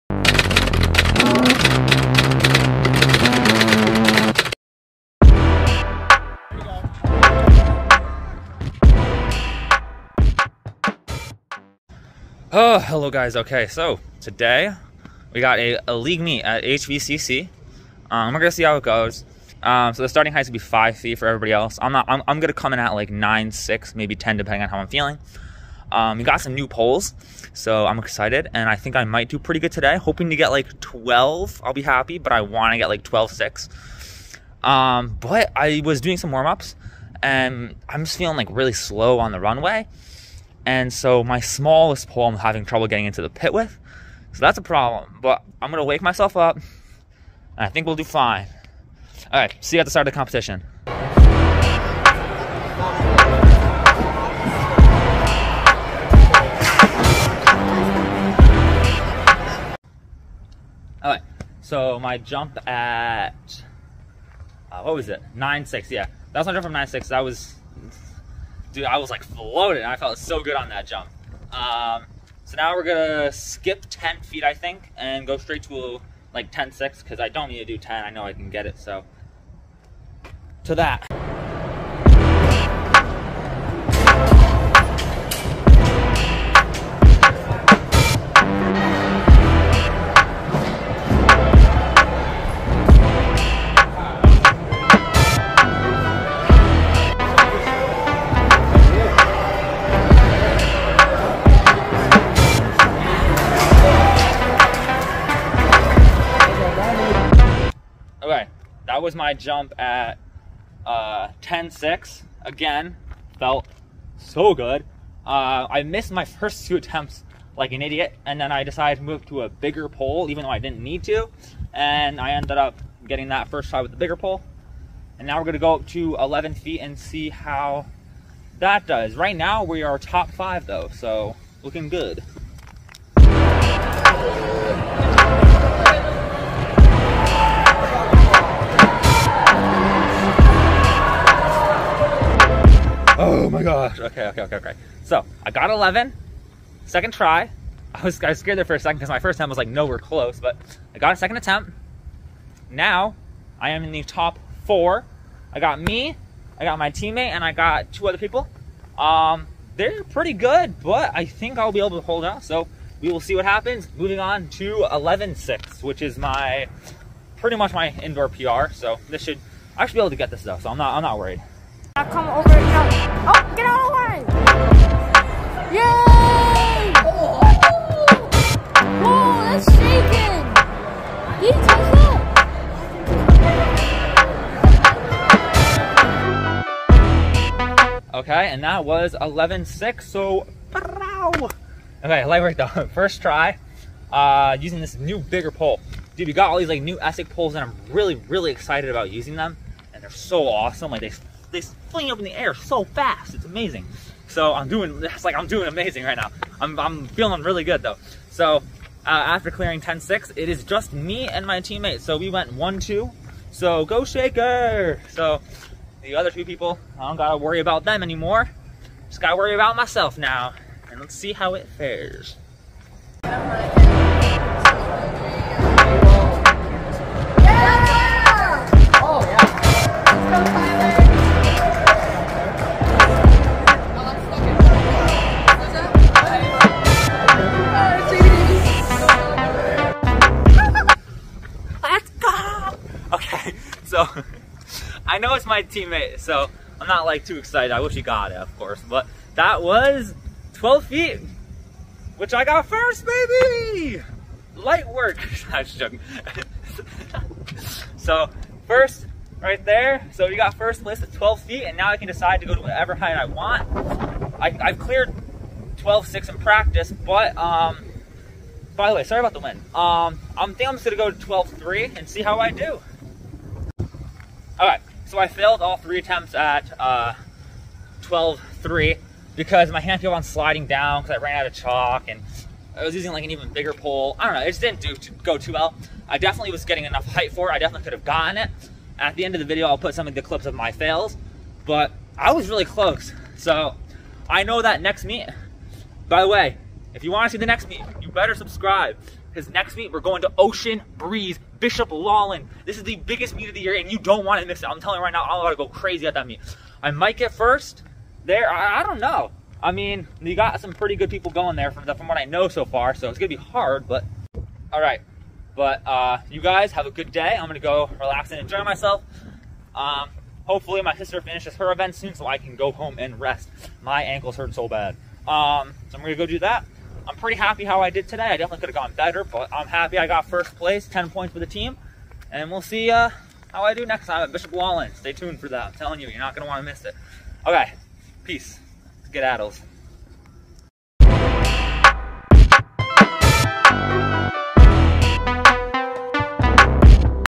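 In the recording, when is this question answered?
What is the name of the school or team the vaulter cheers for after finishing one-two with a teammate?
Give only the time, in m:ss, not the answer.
3:34.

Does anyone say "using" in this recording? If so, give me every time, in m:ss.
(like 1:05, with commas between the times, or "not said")
3:14, 3:19, 4:42.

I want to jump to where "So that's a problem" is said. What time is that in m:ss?
0:44.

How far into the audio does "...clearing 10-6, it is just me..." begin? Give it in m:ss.
3:29.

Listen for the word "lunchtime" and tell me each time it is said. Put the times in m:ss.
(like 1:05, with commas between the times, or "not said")
not said.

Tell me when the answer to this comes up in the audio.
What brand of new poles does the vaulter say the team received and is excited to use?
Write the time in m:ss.
3:16.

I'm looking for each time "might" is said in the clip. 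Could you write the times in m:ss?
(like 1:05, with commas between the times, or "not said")
0:29, 5:06.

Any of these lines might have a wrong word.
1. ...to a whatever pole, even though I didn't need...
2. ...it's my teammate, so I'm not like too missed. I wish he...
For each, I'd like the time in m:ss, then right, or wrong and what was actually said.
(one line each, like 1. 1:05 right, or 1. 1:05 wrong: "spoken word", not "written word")
1. 1:59 wrong: "bigger", not "whatever"
2. 4:05 wrong: "excited", not "missed".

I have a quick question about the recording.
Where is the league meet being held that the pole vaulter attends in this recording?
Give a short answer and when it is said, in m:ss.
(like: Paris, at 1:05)
HVCC, at 0:16.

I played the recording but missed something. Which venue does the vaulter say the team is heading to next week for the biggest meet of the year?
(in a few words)
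Ocean Breeze.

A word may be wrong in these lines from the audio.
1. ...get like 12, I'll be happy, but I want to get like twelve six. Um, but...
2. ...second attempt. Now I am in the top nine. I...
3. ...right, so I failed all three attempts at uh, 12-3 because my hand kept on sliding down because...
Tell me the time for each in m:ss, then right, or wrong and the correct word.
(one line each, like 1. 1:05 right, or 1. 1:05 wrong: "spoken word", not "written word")
1. 0:30 right
2. 2:31 wrong: "four", not "nine"
3. 4:34 right.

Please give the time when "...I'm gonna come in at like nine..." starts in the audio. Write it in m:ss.
0:22.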